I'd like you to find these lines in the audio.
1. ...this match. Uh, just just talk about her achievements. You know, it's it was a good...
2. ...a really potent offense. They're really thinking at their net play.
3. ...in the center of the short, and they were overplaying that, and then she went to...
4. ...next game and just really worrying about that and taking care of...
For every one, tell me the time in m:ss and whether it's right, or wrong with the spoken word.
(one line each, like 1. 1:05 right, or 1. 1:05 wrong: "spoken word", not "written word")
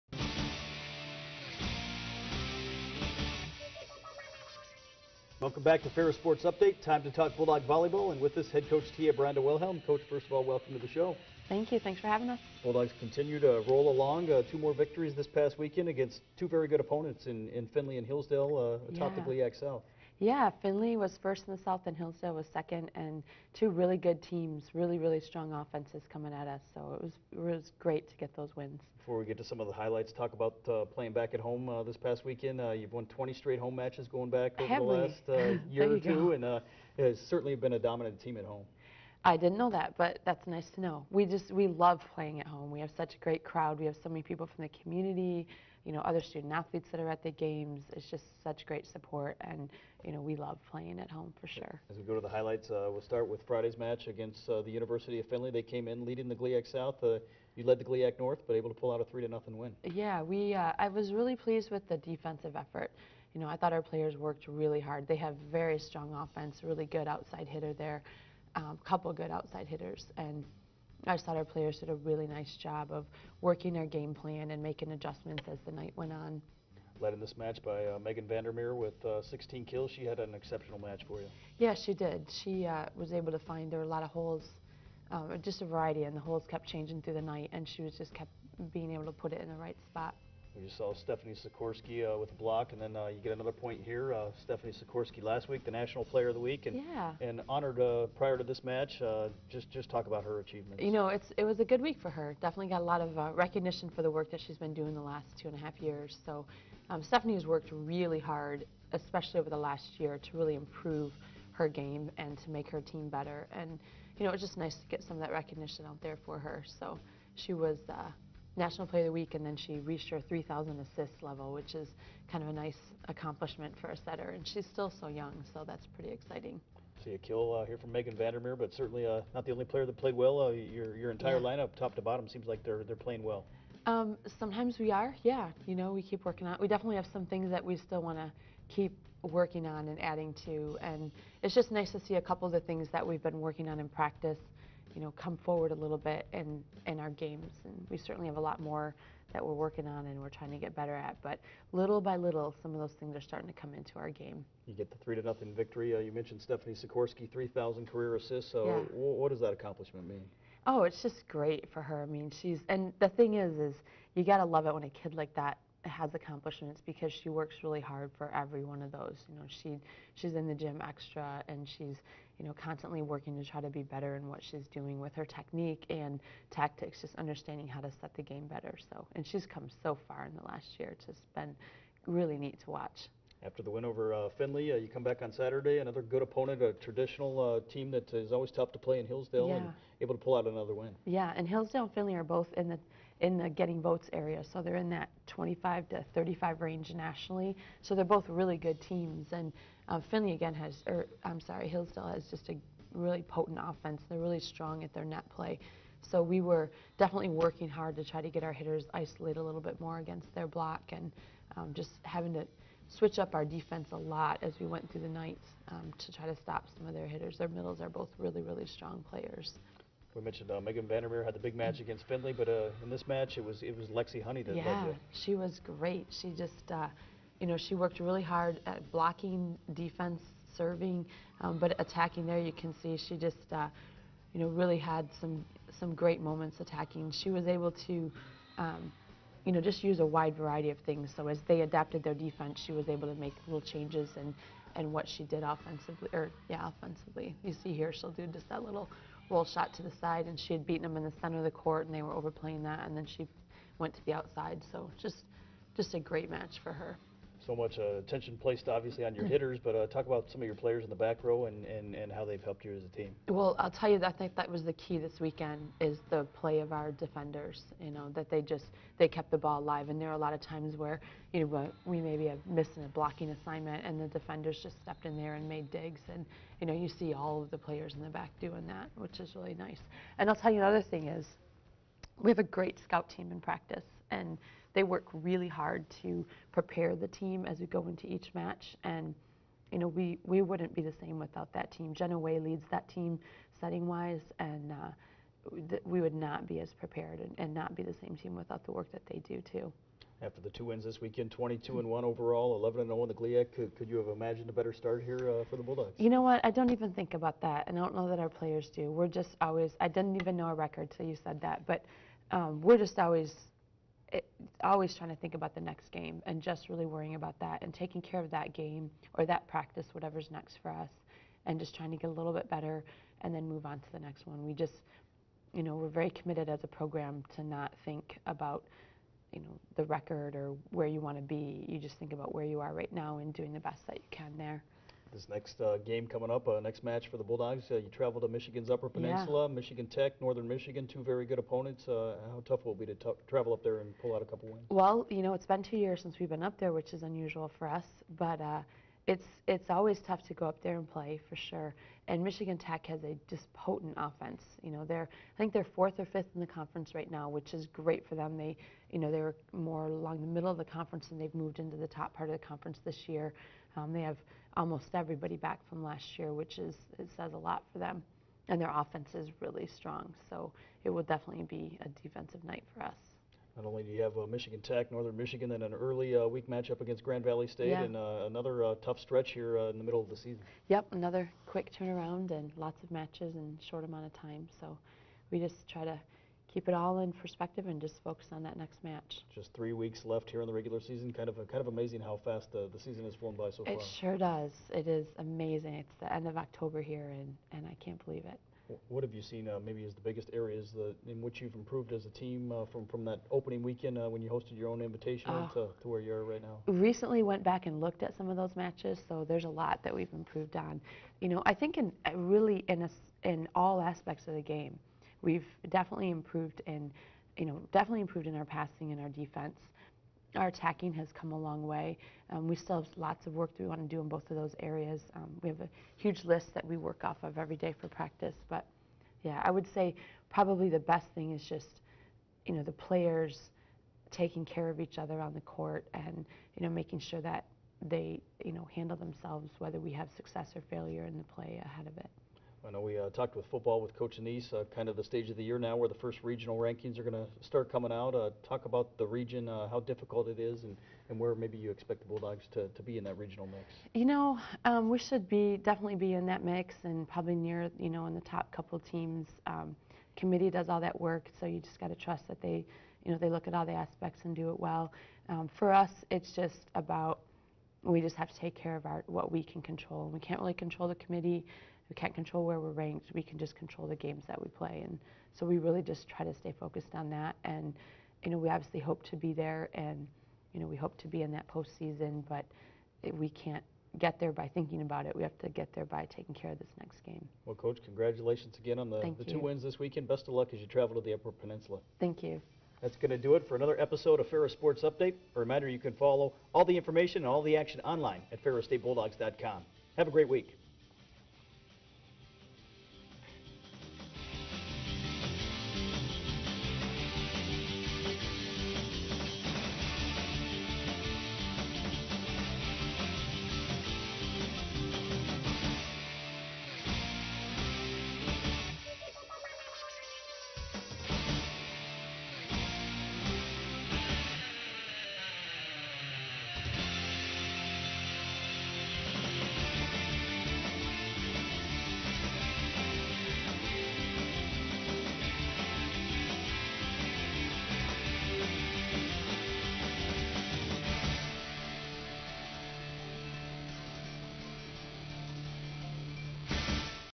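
1. 1:38 right
2. 3:22 wrong: "strong", not "thinking"
3. 4:10 wrong: "court", not "short"
4. 5:15 right.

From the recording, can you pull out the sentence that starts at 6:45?
to, to where you are right now?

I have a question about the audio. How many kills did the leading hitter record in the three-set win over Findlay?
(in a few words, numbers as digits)
16.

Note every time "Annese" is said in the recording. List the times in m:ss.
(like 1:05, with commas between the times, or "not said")
7:24.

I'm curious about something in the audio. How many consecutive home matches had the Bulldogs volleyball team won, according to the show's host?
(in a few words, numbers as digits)
20.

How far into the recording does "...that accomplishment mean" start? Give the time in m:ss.
2:39.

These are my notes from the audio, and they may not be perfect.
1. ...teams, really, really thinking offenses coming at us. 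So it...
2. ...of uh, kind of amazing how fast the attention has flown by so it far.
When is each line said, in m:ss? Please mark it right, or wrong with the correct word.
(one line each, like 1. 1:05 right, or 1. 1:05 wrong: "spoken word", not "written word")
1. 0:24 wrong: "strong", not "thinking"
2. 6:31 wrong: "season", not "attention".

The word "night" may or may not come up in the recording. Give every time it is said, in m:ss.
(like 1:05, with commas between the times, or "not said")
1:15, 1:27, 3:35, 6:12.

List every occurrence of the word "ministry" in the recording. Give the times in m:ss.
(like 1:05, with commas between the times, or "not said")
not said.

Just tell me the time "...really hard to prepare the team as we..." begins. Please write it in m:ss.
4:45.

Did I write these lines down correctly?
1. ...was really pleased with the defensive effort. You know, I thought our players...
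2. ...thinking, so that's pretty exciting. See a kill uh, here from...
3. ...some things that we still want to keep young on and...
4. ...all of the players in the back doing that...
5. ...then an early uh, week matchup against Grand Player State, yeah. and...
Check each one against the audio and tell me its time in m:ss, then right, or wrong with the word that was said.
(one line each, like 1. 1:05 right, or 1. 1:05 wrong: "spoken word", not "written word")
1. 1:00 right
2. 2:05 wrong: "young", not "thinking"
3. 2:17 wrong: "working", not "young"
4. 4:37 right
5. 6:15 wrong: "Valley", not "Player".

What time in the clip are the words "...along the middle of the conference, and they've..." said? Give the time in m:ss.
5:59.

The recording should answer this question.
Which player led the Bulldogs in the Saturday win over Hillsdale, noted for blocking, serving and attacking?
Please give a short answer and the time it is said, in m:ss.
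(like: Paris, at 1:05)
Lexi Honey, at 3:43.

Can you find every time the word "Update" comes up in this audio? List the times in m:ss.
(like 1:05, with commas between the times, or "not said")
0:06, 8:14.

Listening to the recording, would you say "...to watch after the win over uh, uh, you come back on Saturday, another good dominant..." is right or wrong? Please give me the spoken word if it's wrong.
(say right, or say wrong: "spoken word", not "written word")
wrong: "opponent", not "dominant".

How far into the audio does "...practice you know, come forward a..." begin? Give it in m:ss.
2:23.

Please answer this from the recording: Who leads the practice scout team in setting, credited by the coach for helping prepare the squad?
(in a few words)
Jenna Way.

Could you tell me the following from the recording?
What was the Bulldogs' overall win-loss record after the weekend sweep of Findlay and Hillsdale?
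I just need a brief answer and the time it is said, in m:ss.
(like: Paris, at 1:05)
22-1, at 5:01.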